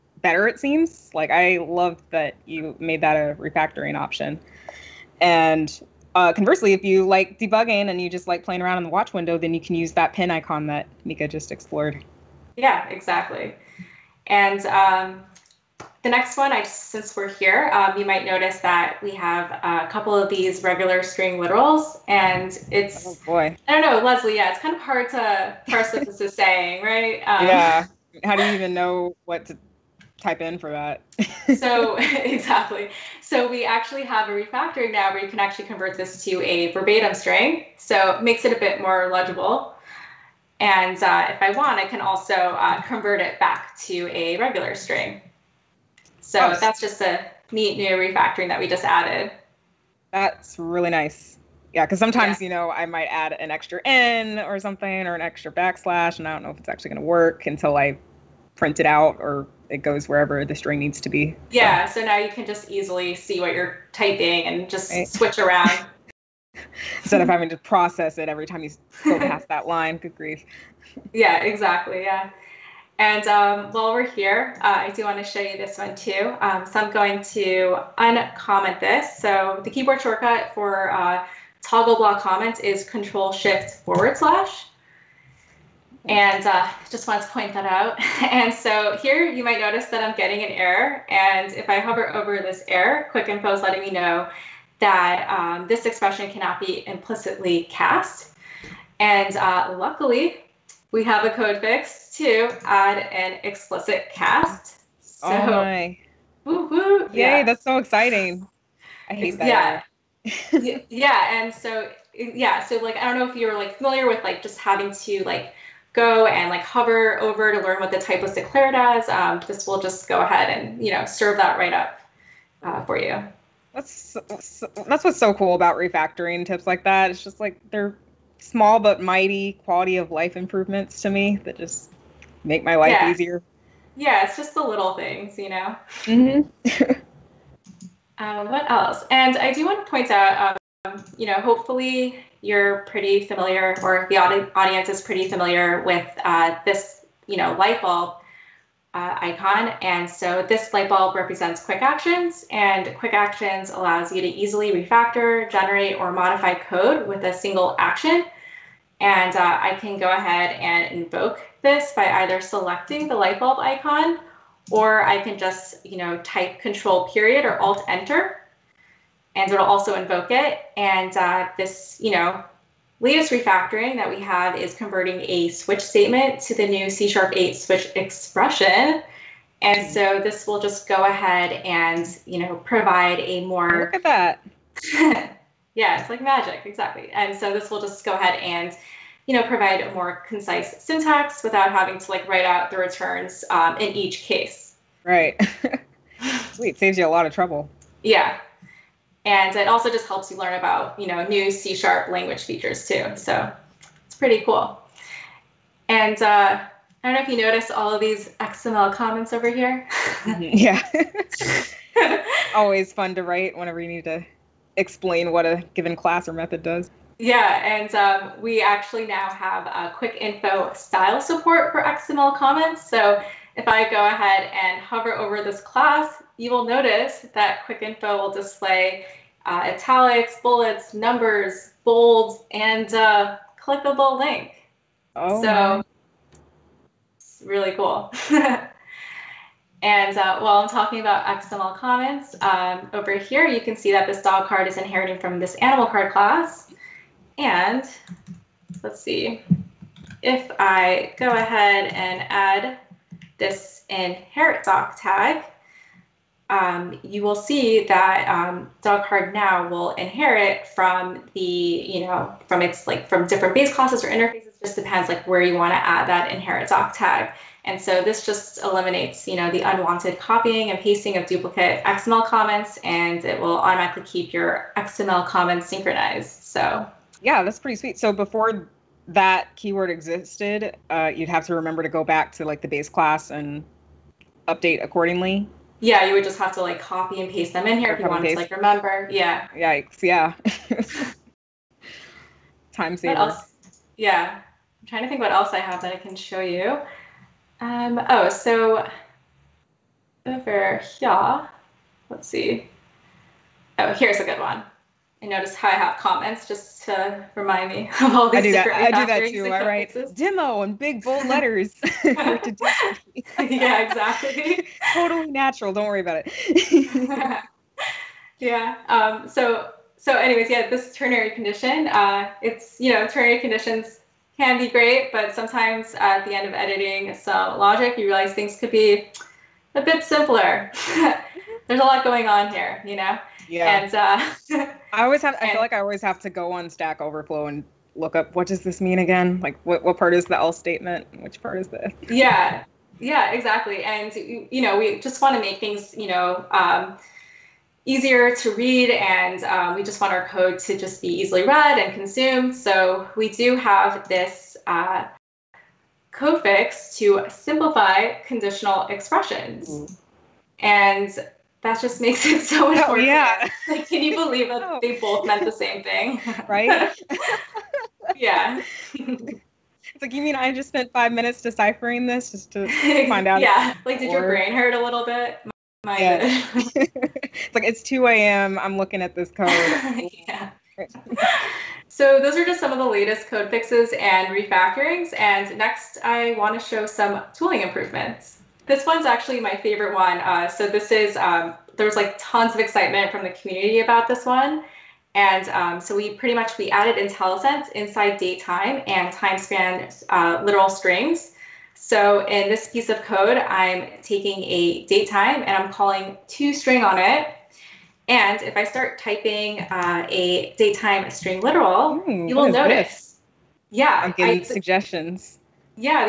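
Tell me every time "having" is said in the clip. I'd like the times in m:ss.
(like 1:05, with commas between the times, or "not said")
1:07, 1:54, 3:11.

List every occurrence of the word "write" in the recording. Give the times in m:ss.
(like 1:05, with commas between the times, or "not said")
3:12, 3:33.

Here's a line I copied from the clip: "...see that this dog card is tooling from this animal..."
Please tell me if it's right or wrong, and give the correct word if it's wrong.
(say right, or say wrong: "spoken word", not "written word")
wrong: "inheriting", not "tooling".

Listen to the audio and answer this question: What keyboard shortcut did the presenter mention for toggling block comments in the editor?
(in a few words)
Control Shift forward slash.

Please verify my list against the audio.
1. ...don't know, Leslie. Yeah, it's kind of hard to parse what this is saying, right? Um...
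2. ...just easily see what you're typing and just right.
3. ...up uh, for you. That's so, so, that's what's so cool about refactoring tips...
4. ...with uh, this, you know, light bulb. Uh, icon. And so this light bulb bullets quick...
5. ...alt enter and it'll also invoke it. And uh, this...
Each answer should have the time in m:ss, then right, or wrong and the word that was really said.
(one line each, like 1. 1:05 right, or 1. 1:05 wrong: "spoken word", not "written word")
1. 0:23 right
2. 1:02 right
3. 2:01 right
4. 2:25 wrong: "represents", not "bullets"
5. 2:47 right.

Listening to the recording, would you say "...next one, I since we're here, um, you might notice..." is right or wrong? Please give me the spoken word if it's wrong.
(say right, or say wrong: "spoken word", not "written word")
right.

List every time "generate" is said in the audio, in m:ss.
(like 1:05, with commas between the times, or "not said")
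2:35.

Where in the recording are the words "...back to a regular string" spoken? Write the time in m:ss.
0:43.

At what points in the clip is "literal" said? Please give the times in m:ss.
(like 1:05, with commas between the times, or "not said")
0:21, 6:40, 6:51.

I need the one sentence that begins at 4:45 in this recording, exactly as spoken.
Yeah, you would just have to like copy and paste them in here or if you wanted to like remember.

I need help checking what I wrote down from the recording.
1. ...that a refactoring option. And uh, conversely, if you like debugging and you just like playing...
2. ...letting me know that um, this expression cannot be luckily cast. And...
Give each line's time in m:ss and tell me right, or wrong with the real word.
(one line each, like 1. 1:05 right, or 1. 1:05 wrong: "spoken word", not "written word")
1. 0:03 right
2. 1:33 wrong: "implicitly", not "luckily".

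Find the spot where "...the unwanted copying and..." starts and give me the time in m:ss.
4:29.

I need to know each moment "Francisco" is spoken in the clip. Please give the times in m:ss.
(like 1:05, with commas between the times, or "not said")
not said.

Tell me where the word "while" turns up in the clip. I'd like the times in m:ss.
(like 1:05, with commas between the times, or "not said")
1:13, 4:00.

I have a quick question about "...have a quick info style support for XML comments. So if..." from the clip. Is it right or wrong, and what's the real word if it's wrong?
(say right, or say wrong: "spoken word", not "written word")
right.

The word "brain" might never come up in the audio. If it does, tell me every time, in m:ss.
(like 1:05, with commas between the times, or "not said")
6:14.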